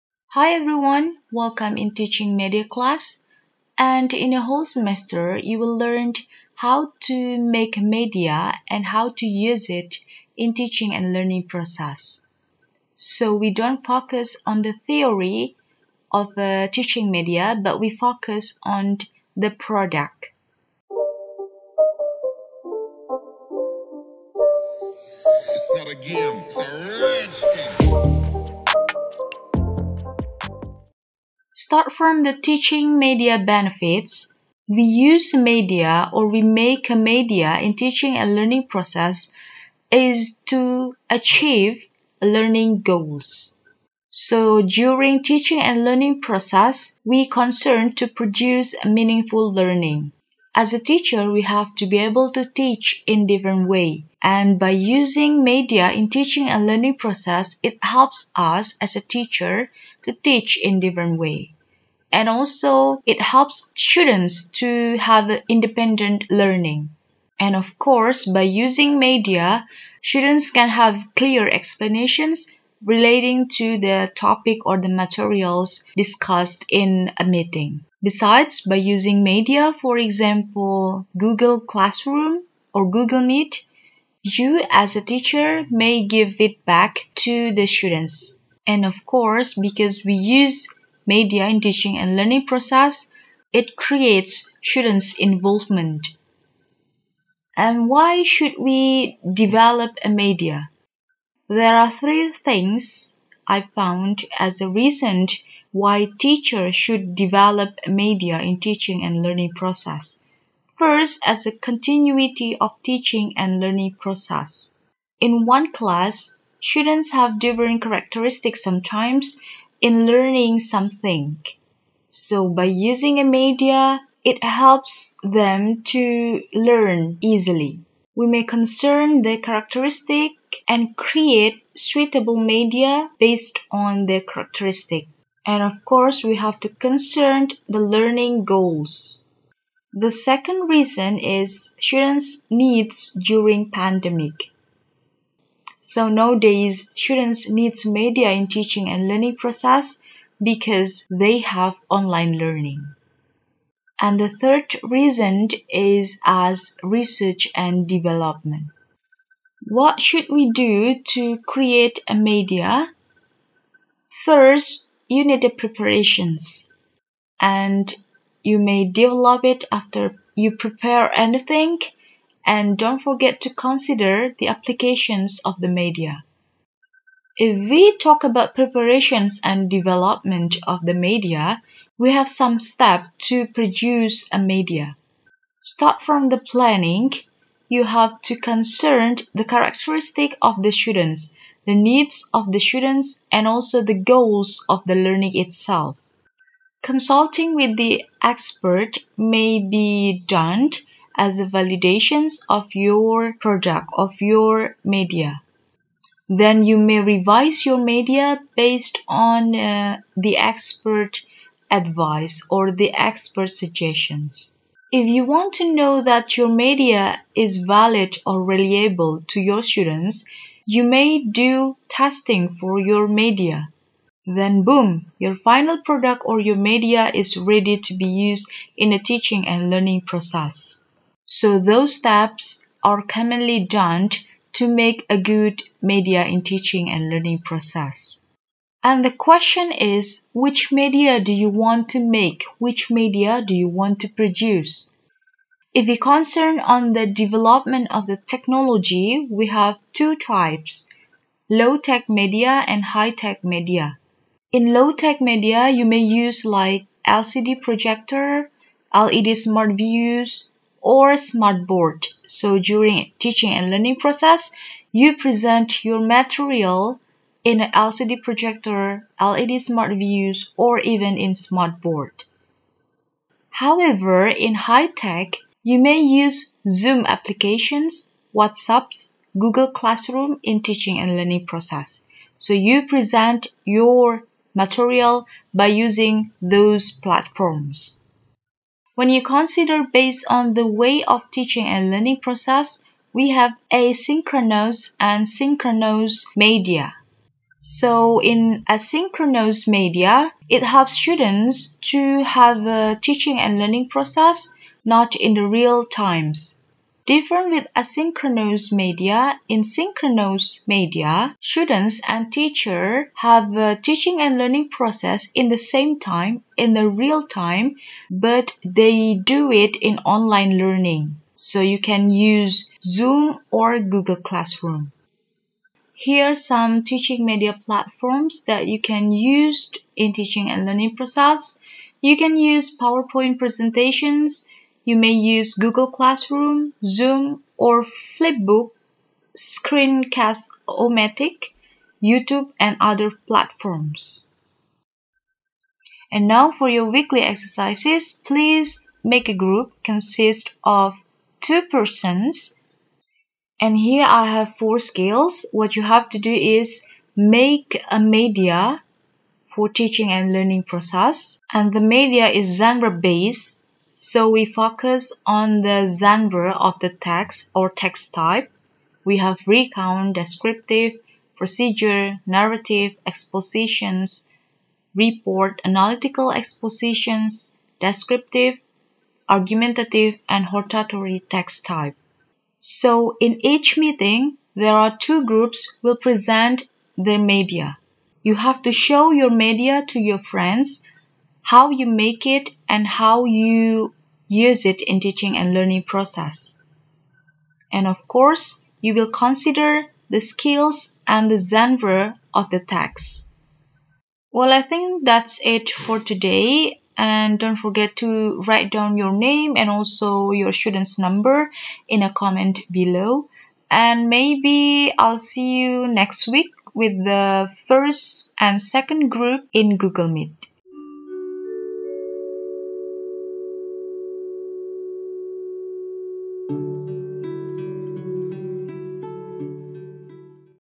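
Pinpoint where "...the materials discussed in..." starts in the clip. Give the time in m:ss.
1:14.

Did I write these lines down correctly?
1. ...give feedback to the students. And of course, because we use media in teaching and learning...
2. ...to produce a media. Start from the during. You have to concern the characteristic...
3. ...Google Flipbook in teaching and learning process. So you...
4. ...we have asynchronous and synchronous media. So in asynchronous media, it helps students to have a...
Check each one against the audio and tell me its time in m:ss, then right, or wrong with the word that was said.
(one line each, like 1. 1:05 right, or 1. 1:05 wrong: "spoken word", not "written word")
1. 1:26 right
2. 3:03 wrong: "planning", not "during"
3. 4:39 wrong: "Classroom", not "Flipbook"
4. 4:53 right.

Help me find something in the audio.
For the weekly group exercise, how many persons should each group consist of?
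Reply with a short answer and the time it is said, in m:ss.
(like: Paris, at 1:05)
2, at 5:51.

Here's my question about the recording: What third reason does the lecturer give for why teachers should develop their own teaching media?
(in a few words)
Research and development.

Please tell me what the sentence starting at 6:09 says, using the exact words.
We have recount, descriptive, procedure, narrative, expositions, report, analytical expositions, descriptive, argumentative, and hortatory text type.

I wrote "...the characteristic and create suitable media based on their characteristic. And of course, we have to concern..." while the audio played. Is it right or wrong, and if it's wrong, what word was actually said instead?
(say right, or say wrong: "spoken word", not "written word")
right.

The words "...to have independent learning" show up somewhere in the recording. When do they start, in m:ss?
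1:04.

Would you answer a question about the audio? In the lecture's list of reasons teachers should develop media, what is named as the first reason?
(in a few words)
Continuity of teaching and learning process.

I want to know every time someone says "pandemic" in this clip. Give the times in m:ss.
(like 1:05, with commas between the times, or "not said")
2:23.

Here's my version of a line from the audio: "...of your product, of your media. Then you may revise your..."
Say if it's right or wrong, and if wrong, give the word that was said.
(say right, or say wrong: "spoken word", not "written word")
right.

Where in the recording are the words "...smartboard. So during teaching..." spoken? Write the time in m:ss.
4:21.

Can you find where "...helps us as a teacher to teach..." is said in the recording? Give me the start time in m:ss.
0:57.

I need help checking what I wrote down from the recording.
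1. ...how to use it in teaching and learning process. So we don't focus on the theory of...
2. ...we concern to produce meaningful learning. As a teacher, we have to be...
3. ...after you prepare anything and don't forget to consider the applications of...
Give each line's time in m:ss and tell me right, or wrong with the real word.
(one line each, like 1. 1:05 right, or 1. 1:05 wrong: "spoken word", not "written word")
1. 0:08 right
2. 0:47 right
3. 2:49 right.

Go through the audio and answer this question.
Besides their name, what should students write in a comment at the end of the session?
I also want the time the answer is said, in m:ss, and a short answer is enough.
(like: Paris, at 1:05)
Student's number, at 6:50.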